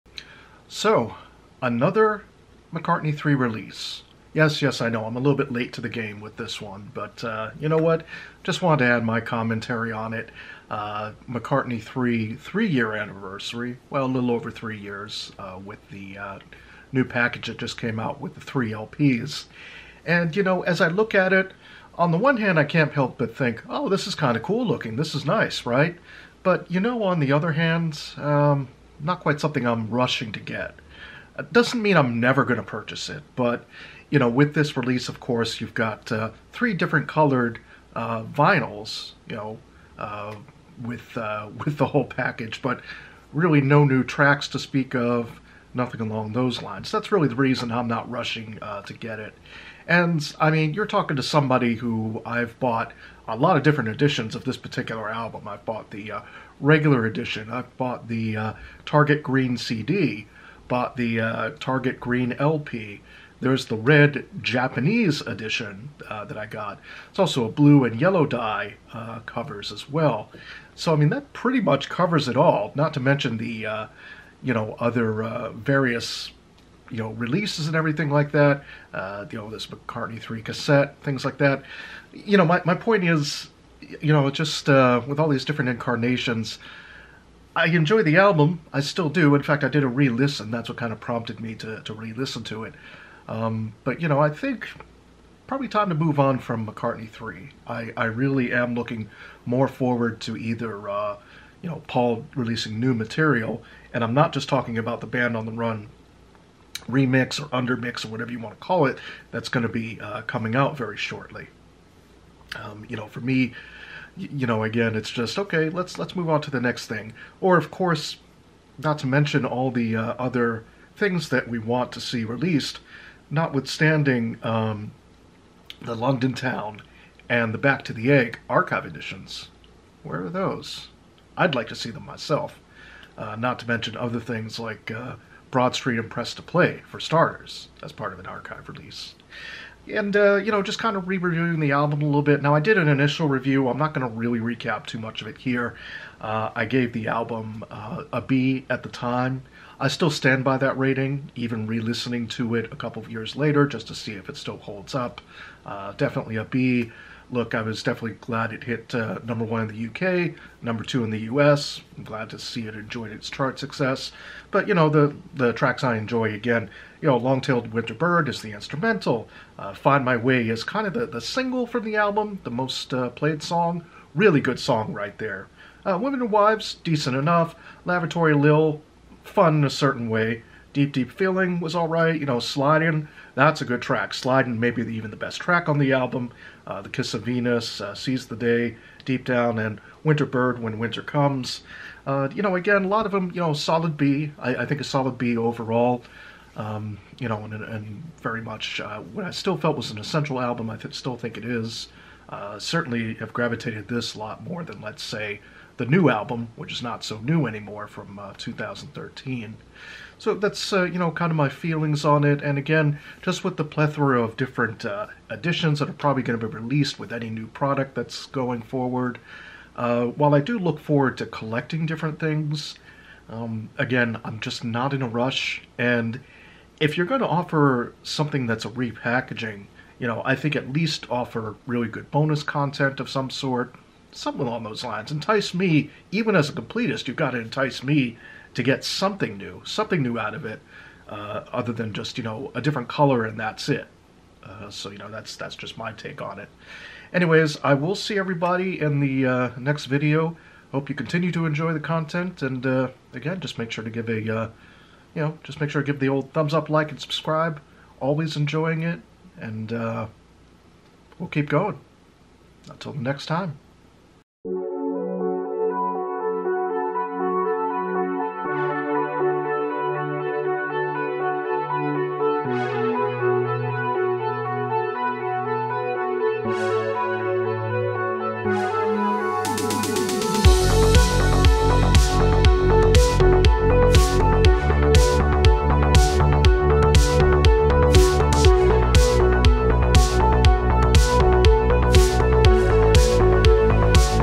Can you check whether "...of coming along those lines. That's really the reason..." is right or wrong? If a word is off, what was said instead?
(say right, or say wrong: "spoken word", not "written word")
wrong: "nothing", not "coming".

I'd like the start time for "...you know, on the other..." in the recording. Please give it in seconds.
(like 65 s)
26 s.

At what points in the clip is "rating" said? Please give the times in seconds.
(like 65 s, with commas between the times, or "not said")
150 s.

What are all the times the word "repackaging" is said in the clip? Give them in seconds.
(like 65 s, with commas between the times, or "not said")
228 s.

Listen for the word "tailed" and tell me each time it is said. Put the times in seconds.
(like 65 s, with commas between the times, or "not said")
167 s.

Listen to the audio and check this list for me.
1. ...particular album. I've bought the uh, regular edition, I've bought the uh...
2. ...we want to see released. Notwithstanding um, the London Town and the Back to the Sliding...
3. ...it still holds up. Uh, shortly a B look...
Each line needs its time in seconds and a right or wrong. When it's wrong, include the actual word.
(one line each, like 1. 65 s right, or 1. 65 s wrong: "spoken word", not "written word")
1. 54 s right
2. 121 s wrong: "Egg", not "Sliding"
3. 154 s wrong: "definitely", not "shortly".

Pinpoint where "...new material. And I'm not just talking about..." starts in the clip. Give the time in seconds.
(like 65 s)
102 s.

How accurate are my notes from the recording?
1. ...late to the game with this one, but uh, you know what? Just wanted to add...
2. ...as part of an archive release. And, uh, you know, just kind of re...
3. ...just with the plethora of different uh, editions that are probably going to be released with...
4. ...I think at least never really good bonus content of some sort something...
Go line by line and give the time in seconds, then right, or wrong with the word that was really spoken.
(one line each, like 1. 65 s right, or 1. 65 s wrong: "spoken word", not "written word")
1. 5 s right
2. 137 s right
3. 213 s right
4. 230 s wrong: "offer", not "never".